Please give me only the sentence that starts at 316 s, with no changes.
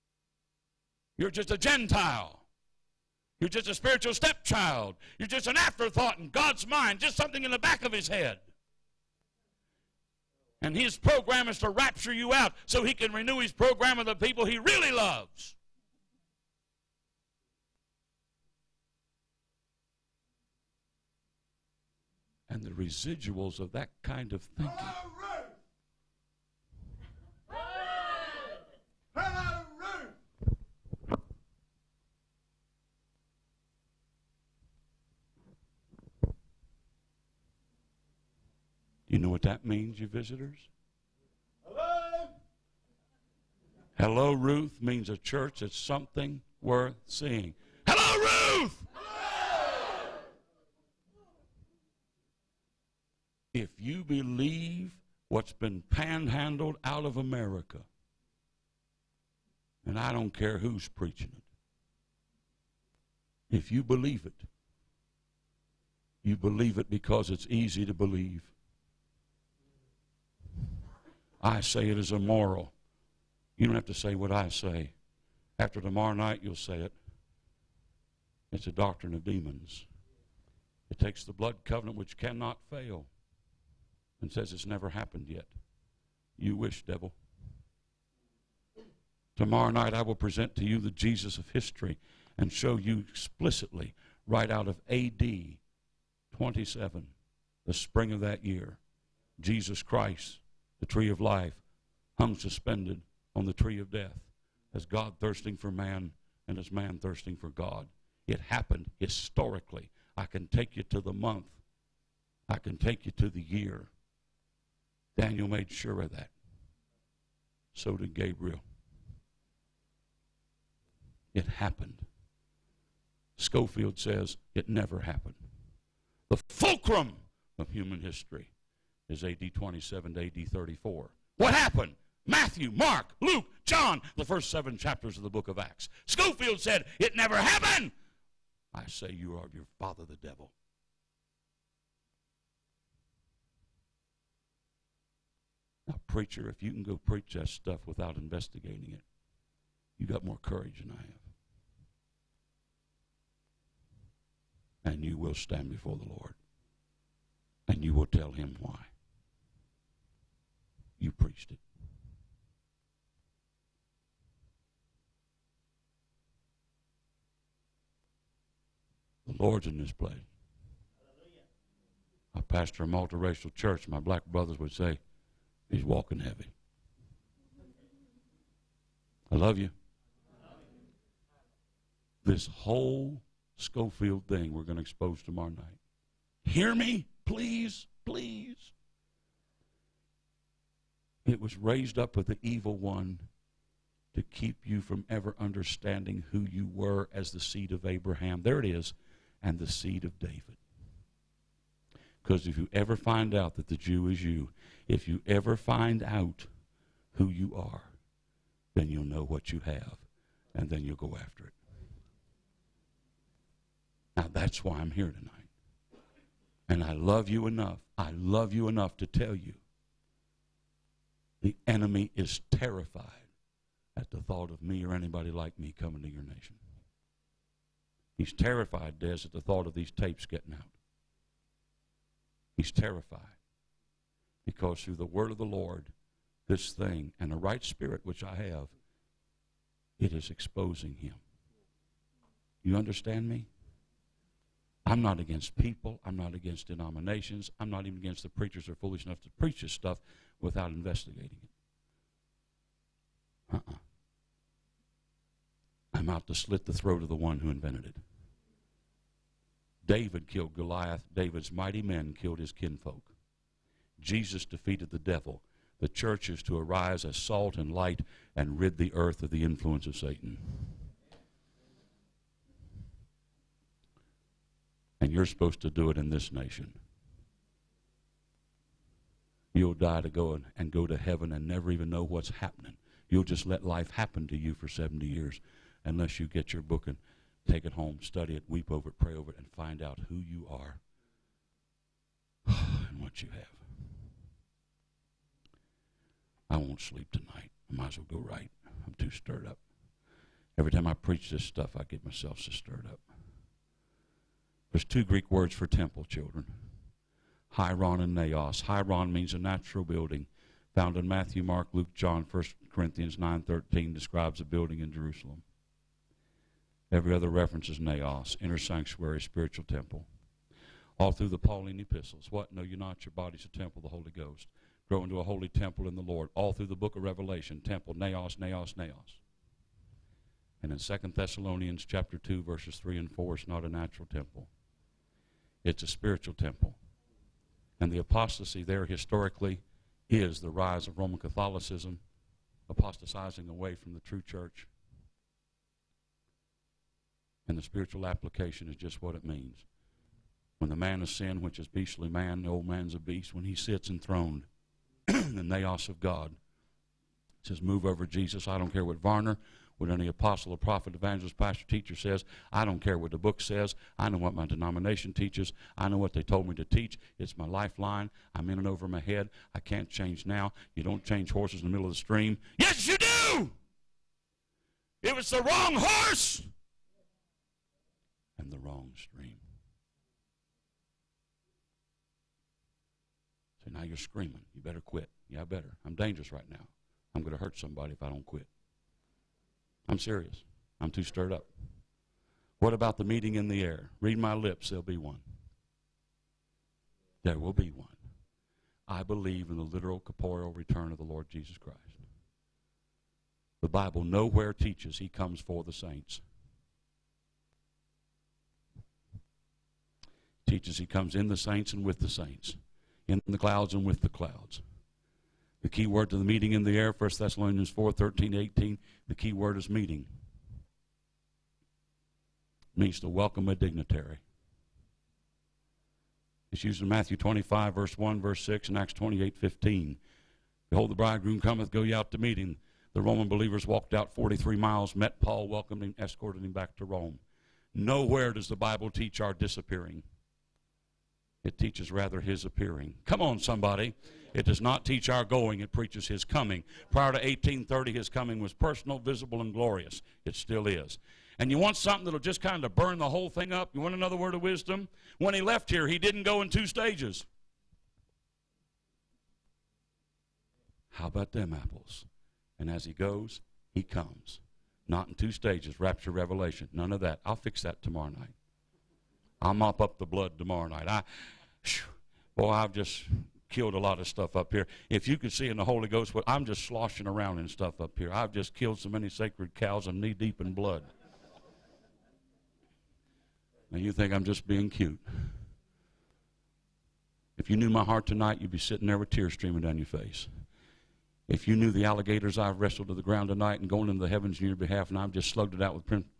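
Every other reference is naos, inner sanctuary, spiritual temple.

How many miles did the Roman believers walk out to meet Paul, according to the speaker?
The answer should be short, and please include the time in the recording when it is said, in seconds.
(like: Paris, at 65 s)
43, at 434 s.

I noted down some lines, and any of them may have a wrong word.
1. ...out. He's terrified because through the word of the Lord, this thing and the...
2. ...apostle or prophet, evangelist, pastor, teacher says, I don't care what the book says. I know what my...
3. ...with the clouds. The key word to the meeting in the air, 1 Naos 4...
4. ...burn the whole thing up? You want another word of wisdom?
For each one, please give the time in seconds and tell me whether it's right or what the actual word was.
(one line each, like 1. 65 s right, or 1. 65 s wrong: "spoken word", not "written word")
1. 230 s right
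2. 360 s right
3. 413 s wrong: "Thessalonians", not "Naos"
4. 452 s right.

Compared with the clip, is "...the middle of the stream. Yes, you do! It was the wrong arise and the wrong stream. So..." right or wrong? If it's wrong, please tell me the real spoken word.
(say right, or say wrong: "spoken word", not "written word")
wrong: "horse", not "arise".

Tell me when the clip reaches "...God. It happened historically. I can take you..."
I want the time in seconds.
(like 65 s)
107 s.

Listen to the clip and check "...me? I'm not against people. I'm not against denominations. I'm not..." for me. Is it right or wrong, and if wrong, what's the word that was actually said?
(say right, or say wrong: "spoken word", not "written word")
right.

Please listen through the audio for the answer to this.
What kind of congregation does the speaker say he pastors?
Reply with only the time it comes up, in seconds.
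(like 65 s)
172 s.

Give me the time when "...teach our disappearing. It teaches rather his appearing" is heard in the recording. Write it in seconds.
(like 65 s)
438 s.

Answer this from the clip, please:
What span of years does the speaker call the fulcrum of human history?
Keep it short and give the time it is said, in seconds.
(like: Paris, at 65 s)
AD 27 to AD 34, at 129 s.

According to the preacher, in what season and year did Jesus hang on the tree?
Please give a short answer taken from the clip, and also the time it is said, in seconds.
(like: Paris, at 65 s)
spring of AD 27, at 94 s.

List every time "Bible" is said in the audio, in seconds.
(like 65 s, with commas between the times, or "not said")
403 s, 438 s.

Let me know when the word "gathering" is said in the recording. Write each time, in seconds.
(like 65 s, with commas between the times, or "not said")
not said.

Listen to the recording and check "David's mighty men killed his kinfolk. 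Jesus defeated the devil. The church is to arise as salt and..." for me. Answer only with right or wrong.
right.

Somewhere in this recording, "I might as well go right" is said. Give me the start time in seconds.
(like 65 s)
297 s.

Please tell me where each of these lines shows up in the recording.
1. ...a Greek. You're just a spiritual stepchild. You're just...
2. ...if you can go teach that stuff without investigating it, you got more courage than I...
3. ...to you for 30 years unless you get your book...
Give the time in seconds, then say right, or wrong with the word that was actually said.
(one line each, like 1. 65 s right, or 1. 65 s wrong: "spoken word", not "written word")
1. 1 s wrong: "Gentile", not "Greek"
2. 146 s wrong: "preach", not "teach"
3. 284 s wrong: "70", not "30".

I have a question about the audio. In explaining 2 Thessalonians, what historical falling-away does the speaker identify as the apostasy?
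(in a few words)
Roman Catholicism.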